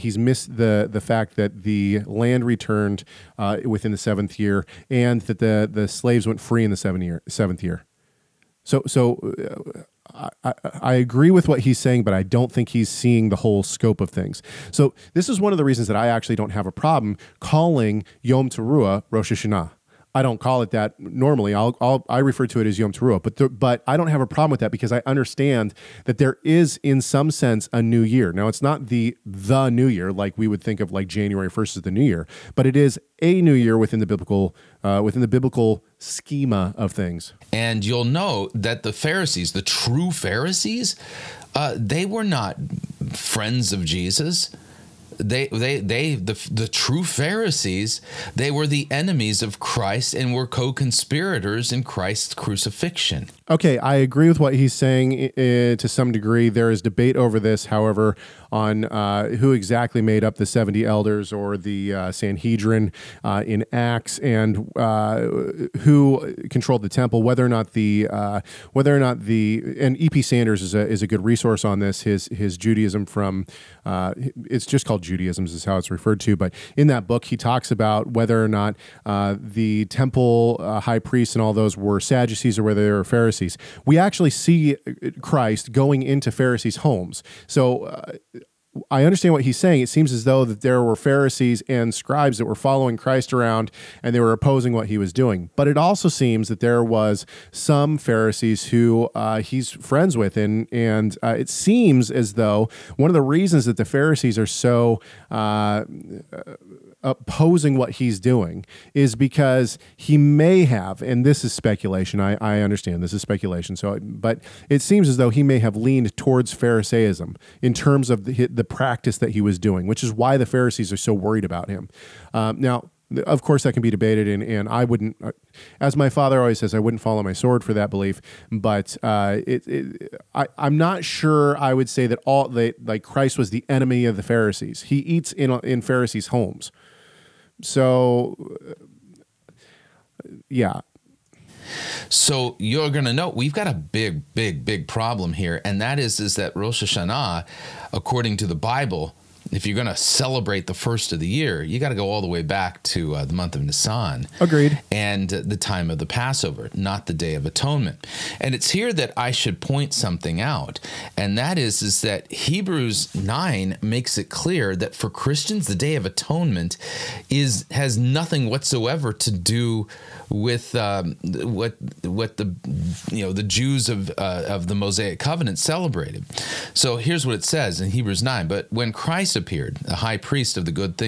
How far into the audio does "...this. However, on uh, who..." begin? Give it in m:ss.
0:57.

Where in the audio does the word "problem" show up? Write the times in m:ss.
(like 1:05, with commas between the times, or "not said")
0:16, 0:24, 2:24.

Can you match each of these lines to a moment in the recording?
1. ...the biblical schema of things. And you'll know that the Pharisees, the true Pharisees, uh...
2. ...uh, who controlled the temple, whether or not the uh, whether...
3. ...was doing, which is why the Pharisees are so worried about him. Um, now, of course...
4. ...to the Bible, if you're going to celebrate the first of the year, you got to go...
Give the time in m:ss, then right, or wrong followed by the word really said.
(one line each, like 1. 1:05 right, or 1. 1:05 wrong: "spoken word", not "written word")
1. 0:35 right
2. 1:04 right
3. 1:59 right
4. 2:28 right.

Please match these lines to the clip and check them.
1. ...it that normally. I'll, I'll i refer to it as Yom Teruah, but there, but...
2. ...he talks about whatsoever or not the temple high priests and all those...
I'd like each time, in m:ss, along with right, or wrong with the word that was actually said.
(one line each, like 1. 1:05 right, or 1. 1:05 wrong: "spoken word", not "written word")
1. 0:20 right
2. 1:17 wrong: "whether", not "whatsoever".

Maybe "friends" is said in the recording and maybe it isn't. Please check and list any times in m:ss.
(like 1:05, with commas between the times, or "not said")
0:43, 1:39.